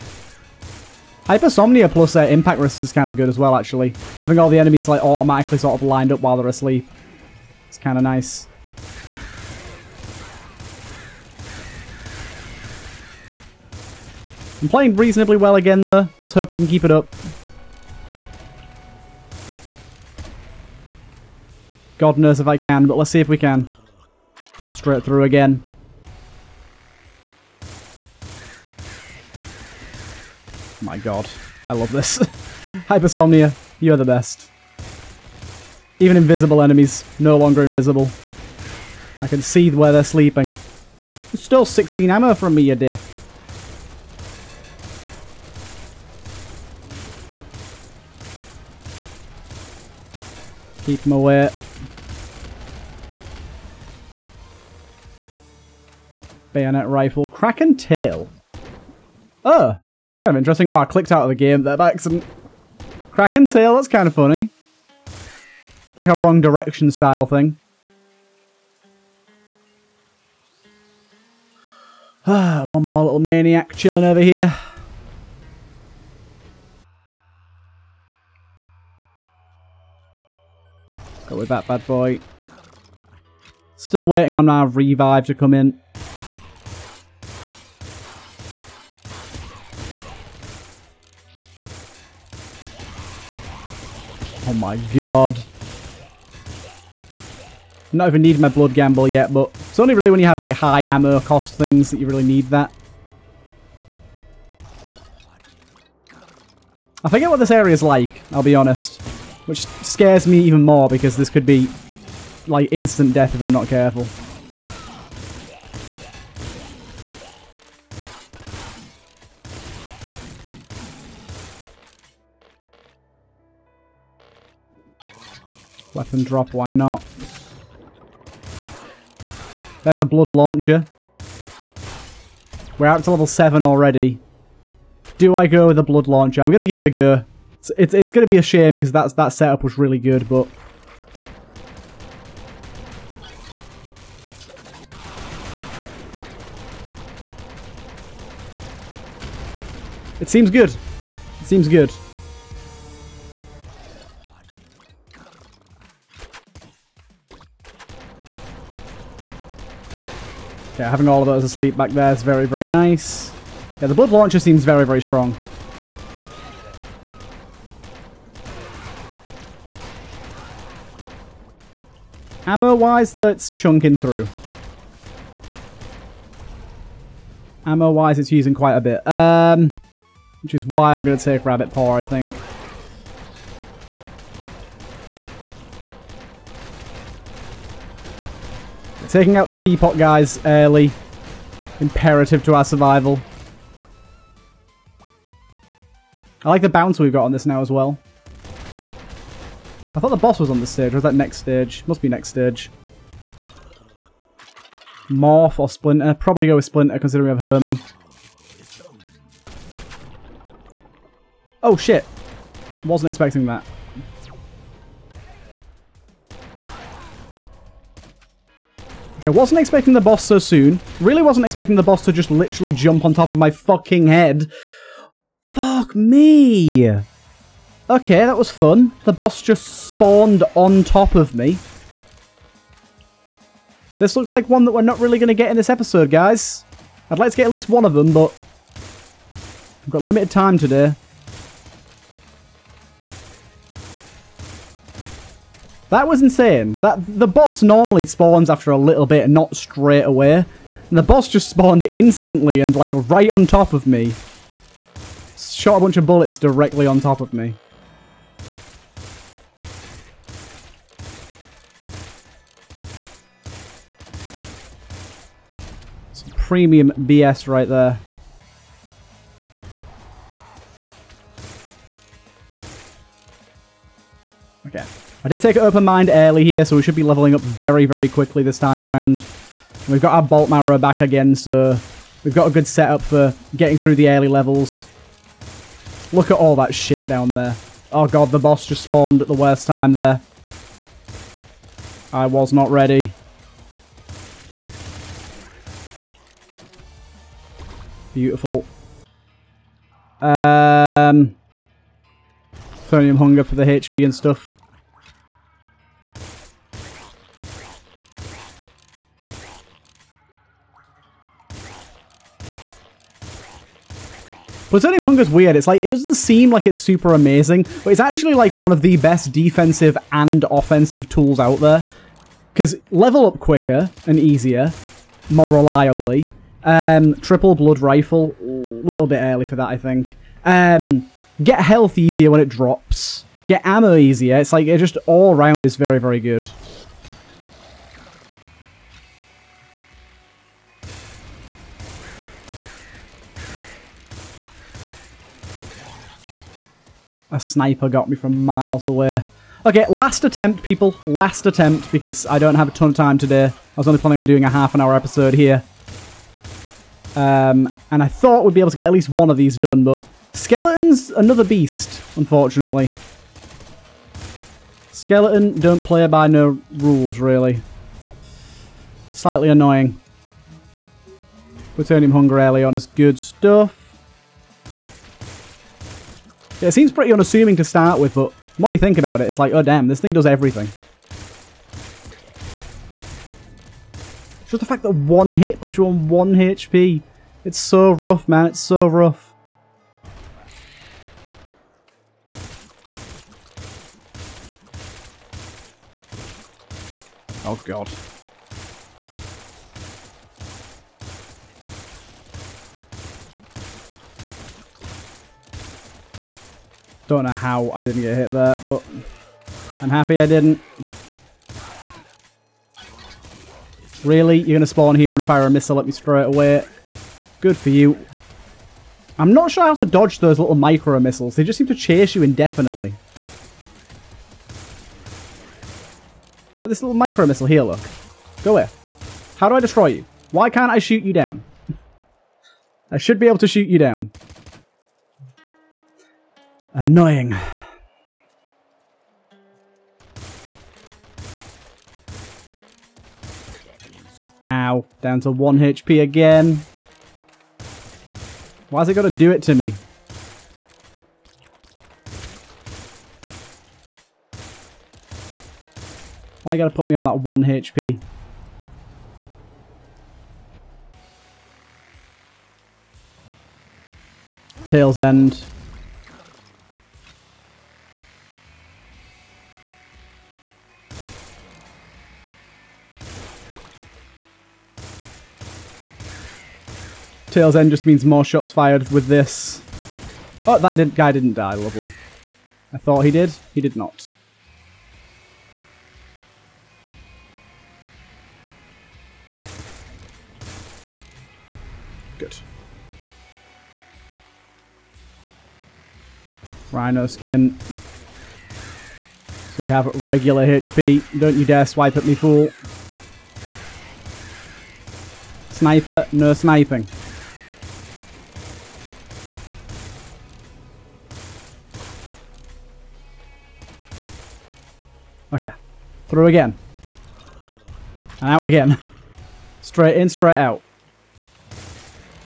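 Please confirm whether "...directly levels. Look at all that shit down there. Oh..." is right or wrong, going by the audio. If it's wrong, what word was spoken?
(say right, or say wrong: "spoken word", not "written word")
wrong: "early", not "directly".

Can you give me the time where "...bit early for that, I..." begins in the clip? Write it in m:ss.
5:29.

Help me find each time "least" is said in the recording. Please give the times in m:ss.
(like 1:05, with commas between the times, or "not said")
3:57, 5:58.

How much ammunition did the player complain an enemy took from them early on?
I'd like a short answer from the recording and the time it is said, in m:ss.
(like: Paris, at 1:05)
16, at 0:41.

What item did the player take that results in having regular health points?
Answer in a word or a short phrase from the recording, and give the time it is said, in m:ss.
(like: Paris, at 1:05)
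Rhino skin, at 8:16.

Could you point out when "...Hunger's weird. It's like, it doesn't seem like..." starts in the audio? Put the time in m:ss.
5:15.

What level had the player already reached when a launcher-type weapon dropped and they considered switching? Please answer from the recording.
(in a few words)
7.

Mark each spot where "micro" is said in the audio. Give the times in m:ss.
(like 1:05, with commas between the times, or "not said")
7:00, 7:06.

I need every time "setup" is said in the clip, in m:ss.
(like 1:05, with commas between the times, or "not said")
2:19, 4:42.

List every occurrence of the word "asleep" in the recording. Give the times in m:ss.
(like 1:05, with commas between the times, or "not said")
0:06, 2:41.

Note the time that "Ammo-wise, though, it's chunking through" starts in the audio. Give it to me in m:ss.
2:52.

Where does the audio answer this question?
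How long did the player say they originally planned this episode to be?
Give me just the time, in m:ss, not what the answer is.
5:54.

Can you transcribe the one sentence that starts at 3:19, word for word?
I thought the boss was on this stage.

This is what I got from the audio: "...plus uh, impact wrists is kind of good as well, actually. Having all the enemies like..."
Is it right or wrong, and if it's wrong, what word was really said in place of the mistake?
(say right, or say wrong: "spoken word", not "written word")
right.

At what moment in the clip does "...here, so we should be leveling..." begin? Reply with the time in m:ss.
4:36.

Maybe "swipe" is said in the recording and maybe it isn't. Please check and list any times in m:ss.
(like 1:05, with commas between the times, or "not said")
8:21.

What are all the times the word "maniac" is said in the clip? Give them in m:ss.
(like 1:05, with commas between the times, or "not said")
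1:13.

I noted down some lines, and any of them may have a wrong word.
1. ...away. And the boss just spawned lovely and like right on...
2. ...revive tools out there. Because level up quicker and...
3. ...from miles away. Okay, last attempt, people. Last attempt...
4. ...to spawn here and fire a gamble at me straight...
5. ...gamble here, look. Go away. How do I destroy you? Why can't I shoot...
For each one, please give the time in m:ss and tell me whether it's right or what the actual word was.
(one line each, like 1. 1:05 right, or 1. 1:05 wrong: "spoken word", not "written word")
1. 4:10 wrong: "instantly", not "lovely"
2. 5:20 wrong: "offensive", not "revive"
3. 5:48 right
4. 6:54 wrong: "missile", not "gamble"
5. 7:07 wrong: "missile", not "gamble".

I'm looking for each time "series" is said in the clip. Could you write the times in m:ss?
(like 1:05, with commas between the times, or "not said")
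not said.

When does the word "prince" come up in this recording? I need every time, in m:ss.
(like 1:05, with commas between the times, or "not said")
not said.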